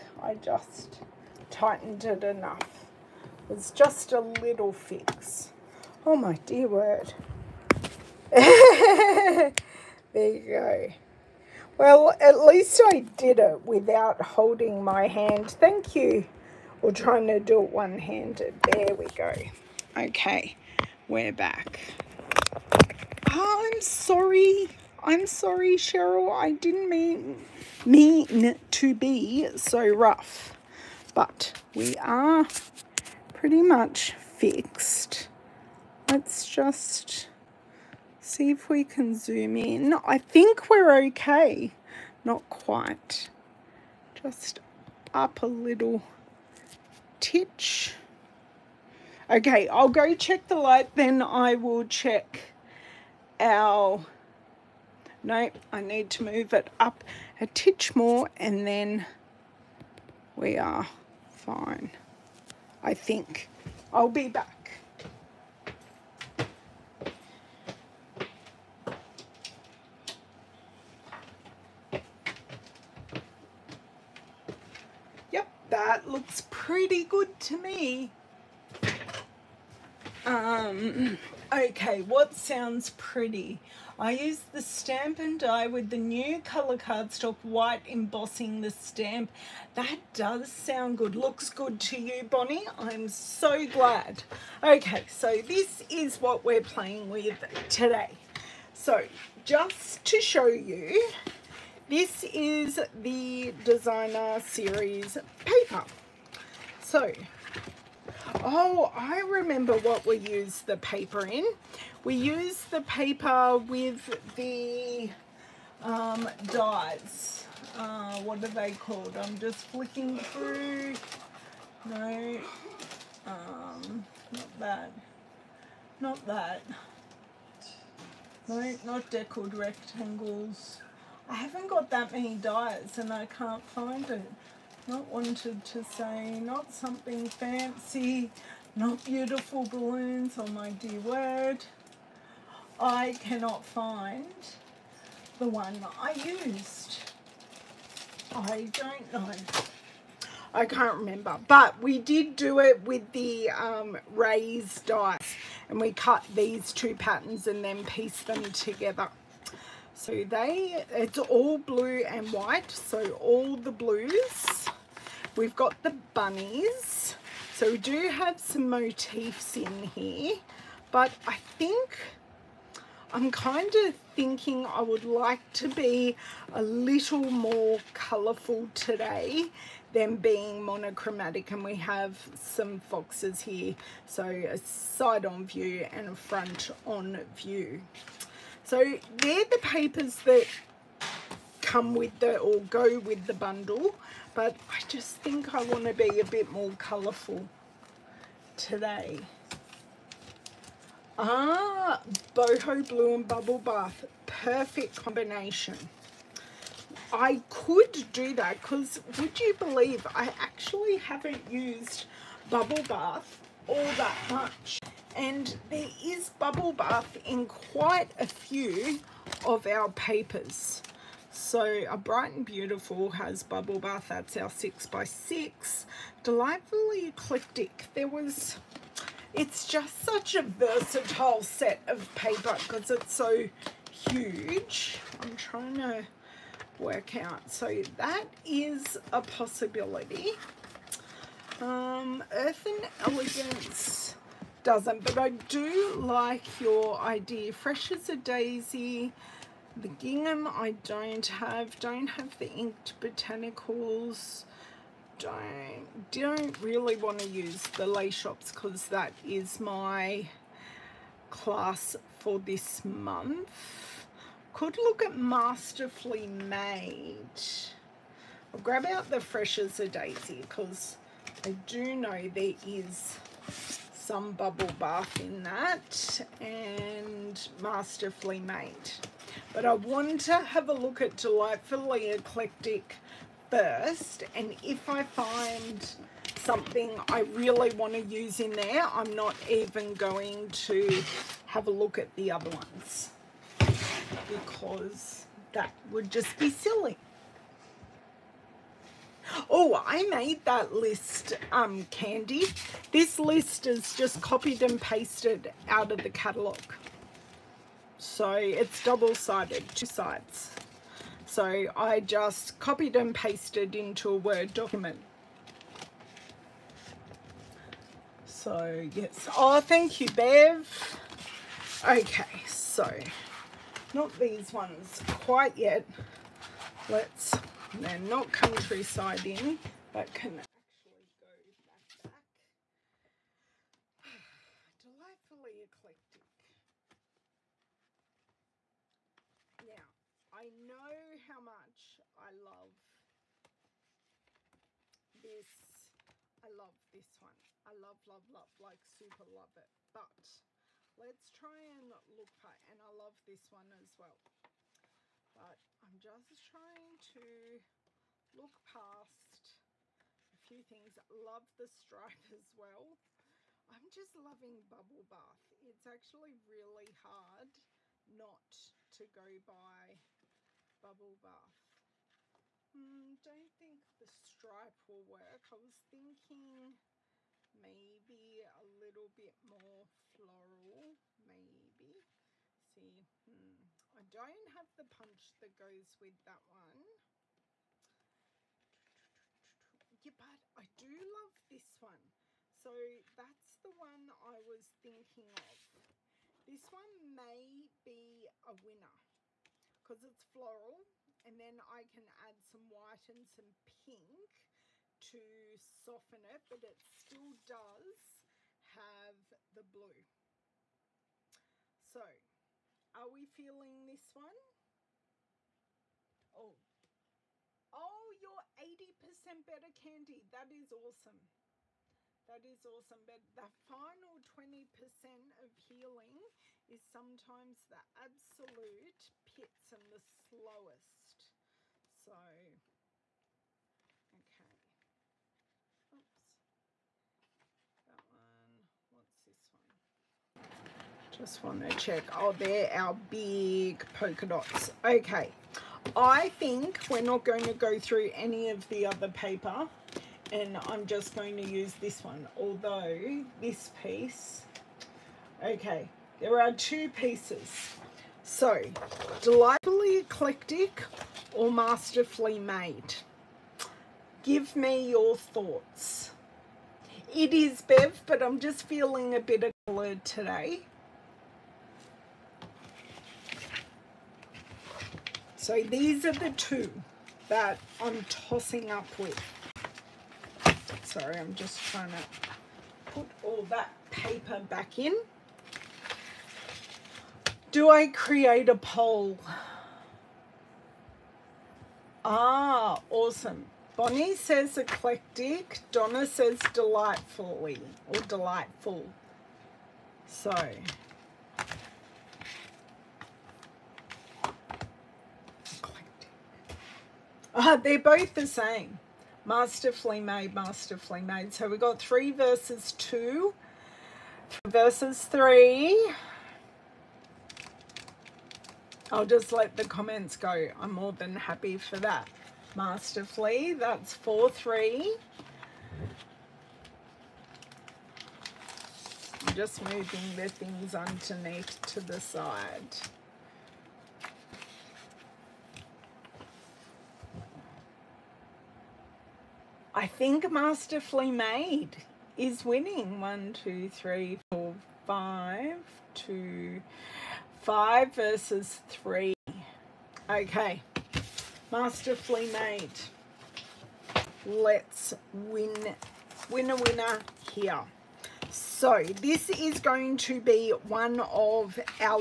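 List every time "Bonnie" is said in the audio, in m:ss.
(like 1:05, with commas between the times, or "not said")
1:32, 8:13.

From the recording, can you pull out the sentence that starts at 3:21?
Ah, boho blue and bubble bath.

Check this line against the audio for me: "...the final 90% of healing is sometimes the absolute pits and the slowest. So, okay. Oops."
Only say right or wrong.
wrong.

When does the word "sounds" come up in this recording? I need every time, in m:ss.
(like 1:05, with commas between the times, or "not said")
1:22, 1:30.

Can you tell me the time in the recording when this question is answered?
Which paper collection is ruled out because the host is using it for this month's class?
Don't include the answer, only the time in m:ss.
4:17.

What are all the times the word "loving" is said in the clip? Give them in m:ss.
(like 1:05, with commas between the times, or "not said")
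6:04.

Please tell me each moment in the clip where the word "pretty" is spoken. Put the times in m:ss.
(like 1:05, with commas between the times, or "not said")
0:33, 1:16, 1:22.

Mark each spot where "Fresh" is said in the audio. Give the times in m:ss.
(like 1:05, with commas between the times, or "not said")
4:07, 4:29.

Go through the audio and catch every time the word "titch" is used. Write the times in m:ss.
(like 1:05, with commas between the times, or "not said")
0:47, 0:57.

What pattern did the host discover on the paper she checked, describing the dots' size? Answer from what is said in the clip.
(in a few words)
big polka dots.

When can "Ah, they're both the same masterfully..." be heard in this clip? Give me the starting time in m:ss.
8:27.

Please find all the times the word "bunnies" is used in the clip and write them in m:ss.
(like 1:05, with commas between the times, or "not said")
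2:46.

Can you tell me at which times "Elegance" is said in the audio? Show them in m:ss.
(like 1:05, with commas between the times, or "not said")
4:03.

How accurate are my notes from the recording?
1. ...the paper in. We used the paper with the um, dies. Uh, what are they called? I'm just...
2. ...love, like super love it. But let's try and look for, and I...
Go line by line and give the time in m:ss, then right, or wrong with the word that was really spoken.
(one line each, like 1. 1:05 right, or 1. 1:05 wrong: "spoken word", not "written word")
1. 1:50 right
2. 5:48 right.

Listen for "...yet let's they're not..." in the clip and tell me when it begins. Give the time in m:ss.
5:25.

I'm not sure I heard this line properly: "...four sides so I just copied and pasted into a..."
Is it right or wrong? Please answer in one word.
wrong.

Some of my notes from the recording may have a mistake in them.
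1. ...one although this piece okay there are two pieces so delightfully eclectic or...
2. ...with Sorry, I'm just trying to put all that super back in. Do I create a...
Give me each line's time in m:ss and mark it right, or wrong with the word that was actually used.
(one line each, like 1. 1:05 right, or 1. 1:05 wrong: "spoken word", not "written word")
1. 7:32 right
2. 7:58 wrong: "paper", not "super".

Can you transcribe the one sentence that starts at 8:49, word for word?
I'm just moving the things underneath to the side.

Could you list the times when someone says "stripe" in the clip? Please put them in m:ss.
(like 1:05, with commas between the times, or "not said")
6:01, 6:14.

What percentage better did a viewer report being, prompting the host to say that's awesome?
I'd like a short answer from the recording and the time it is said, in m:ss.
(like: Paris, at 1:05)
80%, at 6:58.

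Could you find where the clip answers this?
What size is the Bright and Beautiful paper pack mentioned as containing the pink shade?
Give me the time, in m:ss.
3:44.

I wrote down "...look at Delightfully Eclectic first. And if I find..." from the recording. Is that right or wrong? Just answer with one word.
right.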